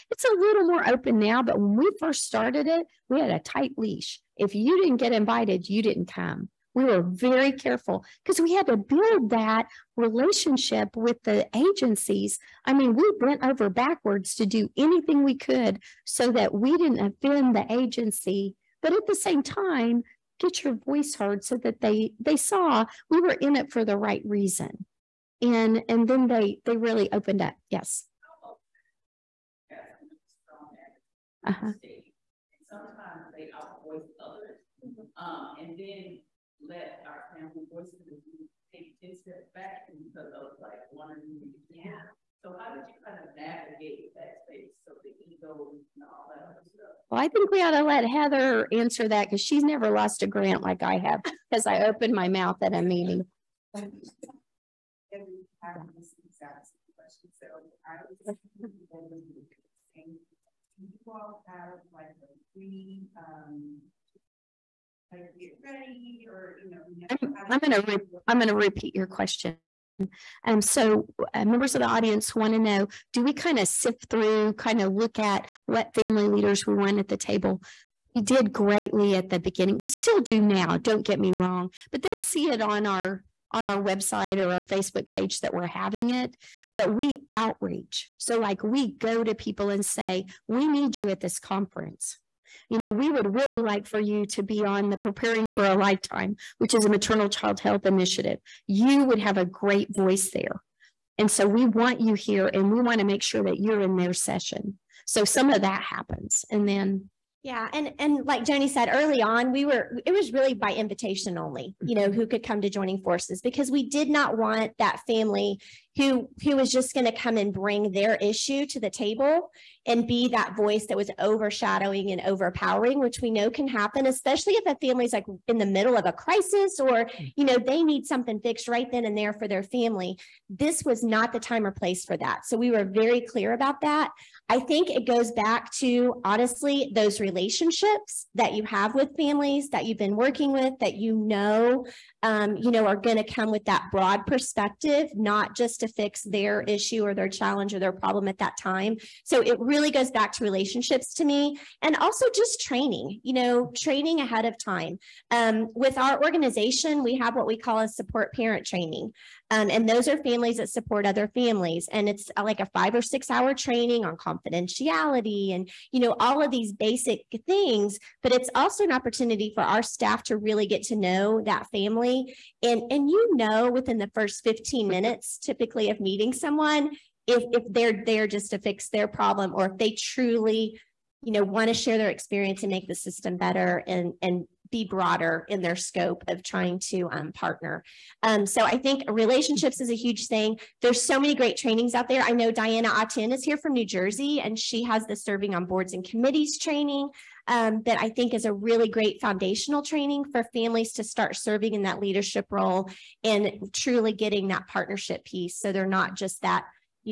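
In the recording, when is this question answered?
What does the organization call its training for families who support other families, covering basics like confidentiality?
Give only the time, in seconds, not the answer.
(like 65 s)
157 s.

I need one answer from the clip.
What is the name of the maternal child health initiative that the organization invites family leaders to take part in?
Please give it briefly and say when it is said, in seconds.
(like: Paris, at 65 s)
Preparing for a Lifetime, at 94 s.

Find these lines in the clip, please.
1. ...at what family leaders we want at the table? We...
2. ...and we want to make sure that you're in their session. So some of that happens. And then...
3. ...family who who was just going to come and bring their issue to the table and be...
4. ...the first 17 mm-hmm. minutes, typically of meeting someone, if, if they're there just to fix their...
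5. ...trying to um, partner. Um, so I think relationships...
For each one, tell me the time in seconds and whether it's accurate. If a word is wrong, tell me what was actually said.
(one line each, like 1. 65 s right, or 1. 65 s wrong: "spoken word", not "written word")
1. 75 s right
2. 102 s right
3. 115 s right
4. 173 s wrong: "15", not "17"
5. 186 s right.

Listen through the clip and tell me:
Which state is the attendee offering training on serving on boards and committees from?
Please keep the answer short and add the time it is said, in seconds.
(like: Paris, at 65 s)
New Jersey, at 193 s.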